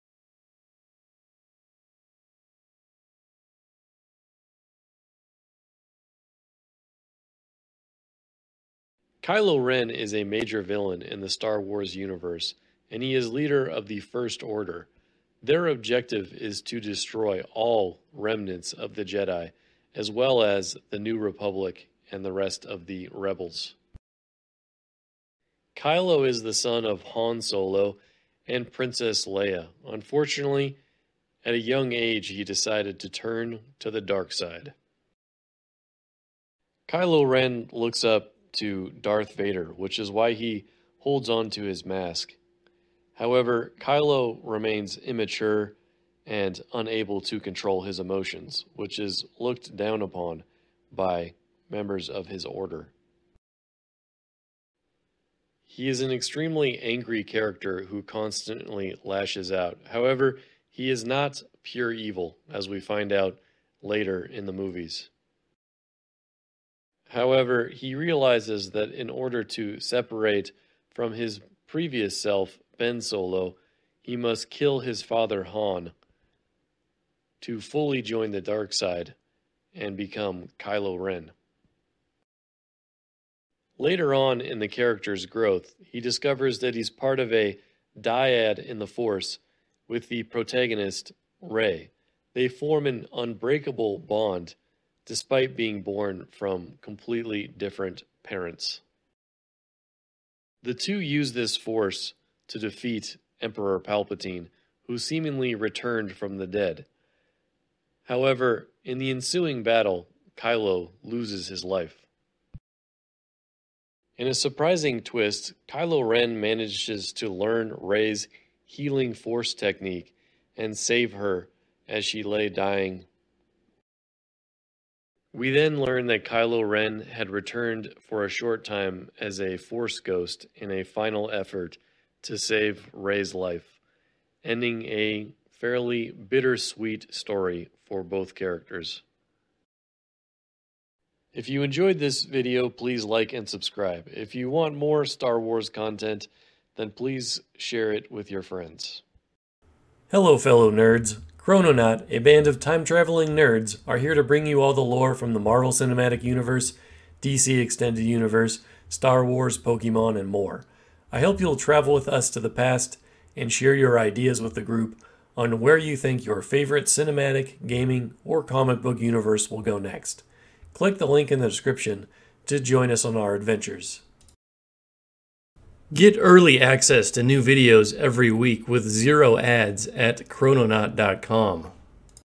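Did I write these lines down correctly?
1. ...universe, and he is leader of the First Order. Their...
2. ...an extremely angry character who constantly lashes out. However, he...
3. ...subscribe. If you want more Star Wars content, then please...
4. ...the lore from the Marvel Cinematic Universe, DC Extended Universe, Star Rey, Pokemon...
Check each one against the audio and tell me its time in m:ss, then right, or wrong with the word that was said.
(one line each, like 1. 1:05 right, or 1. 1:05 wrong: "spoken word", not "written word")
1. 0:11 right
2. 0:56 right
3. 2:23 right
4. 2:34 wrong: "Wars", not "Rey".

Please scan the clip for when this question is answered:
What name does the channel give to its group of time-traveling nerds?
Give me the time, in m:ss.
2:31.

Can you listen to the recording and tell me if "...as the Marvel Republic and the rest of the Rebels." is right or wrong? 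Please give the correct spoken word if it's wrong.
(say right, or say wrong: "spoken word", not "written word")
wrong: "New", not "Marvel".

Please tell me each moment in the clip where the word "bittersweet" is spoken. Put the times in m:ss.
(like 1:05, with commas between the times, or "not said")
2:16.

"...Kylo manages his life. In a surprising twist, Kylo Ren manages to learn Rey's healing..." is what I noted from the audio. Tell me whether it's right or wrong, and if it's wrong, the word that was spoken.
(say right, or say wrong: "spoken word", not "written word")
wrong: "loses", not "manages".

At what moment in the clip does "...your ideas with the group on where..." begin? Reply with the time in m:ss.
2:43.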